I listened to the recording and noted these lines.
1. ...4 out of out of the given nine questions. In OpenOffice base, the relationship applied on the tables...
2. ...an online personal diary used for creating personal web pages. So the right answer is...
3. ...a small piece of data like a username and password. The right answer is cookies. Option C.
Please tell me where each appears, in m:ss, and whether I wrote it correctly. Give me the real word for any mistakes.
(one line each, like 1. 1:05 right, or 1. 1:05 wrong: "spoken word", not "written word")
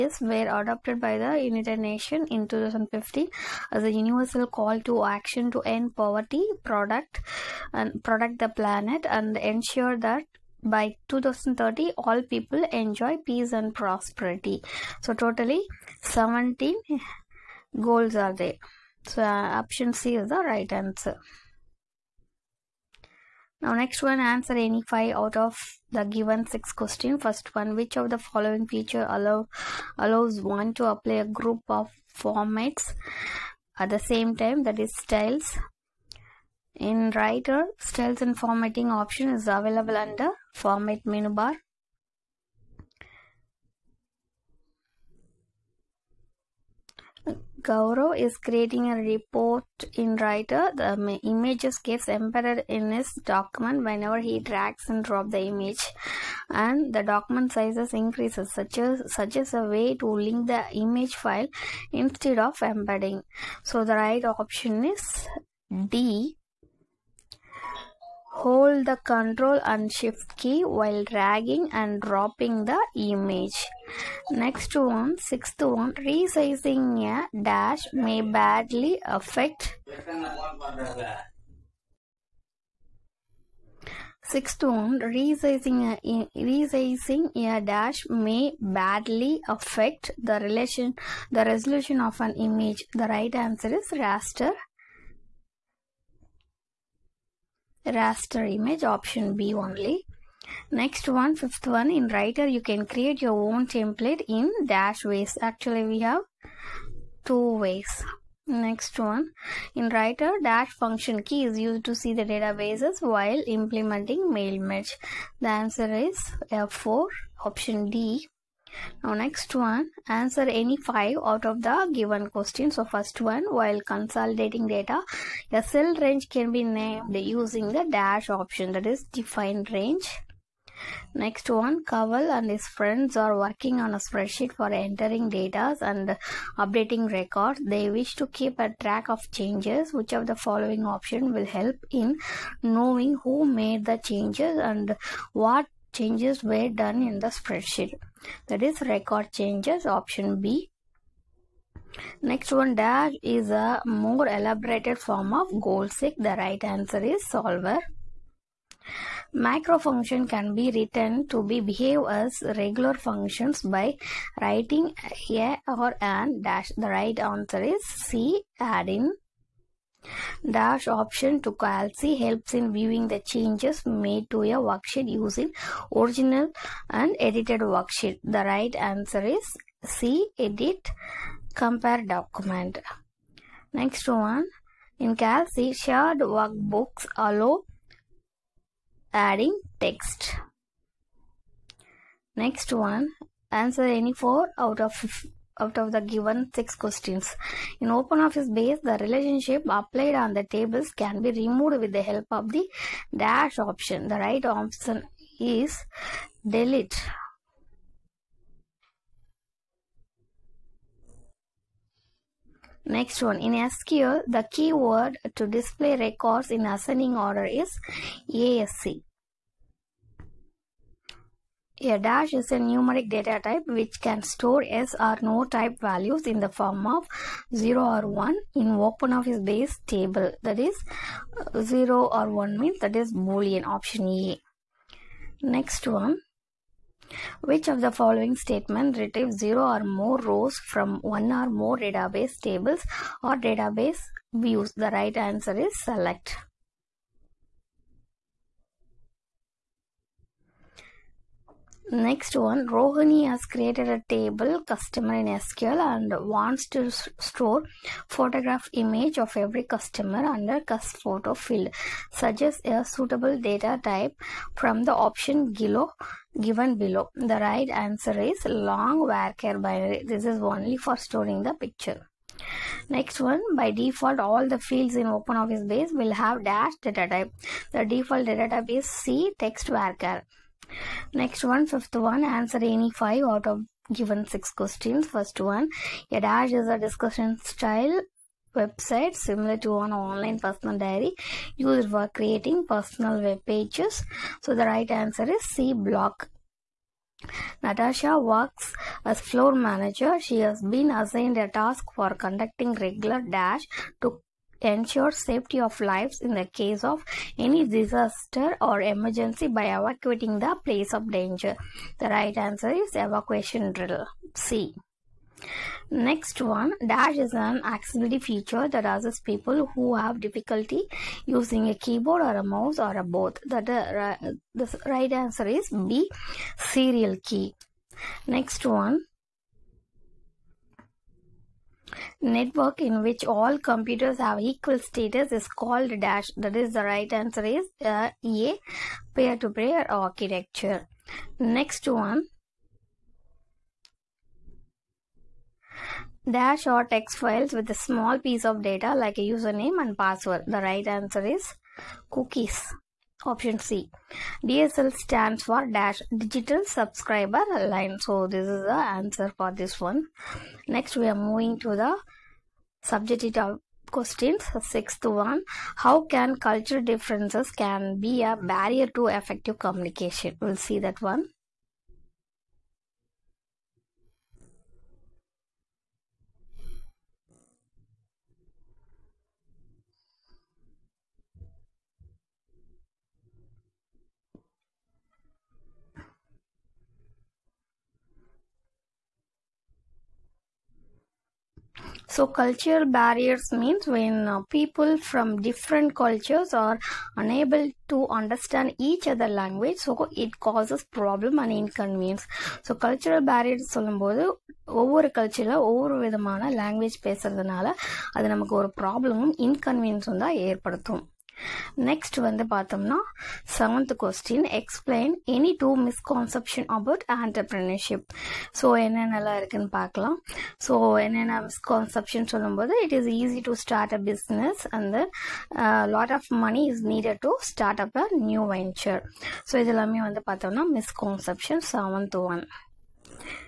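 1. 3:14 wrong: "six", not "nine"
2. 4:49 right
3. 5:47 right.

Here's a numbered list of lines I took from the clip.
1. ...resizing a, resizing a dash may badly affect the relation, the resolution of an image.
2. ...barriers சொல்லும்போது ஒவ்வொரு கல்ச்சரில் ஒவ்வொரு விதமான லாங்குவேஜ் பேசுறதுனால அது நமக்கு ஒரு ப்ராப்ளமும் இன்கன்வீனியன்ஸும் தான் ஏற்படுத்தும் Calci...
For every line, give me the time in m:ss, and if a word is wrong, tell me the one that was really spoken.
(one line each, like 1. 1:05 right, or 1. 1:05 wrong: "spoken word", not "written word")
1. 1:24 right
2. 6:43 wrong: "Next", not "Calci".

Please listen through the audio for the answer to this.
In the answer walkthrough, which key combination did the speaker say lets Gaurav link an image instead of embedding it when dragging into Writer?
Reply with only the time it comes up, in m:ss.
1:08.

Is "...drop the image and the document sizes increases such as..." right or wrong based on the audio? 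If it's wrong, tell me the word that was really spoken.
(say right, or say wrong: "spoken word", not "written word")
right.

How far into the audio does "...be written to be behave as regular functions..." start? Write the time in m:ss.
2:40.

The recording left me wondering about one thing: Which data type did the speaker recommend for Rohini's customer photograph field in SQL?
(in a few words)
Long varchar binary.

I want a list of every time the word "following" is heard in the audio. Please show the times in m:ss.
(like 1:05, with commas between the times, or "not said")
0:28, 2:20, 3:57.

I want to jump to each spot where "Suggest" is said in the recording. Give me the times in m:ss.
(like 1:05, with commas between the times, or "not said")
4:22.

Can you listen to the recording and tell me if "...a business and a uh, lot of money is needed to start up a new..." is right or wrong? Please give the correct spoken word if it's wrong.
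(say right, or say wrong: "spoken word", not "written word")
right.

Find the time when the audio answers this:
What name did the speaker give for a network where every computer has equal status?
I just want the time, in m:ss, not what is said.
5:39.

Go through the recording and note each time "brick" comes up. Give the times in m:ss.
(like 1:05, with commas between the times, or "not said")
not said.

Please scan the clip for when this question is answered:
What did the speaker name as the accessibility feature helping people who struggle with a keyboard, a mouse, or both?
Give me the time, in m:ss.
5:26.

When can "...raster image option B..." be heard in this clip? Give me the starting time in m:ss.
1:37.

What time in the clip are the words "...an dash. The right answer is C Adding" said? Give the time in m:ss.
2:46.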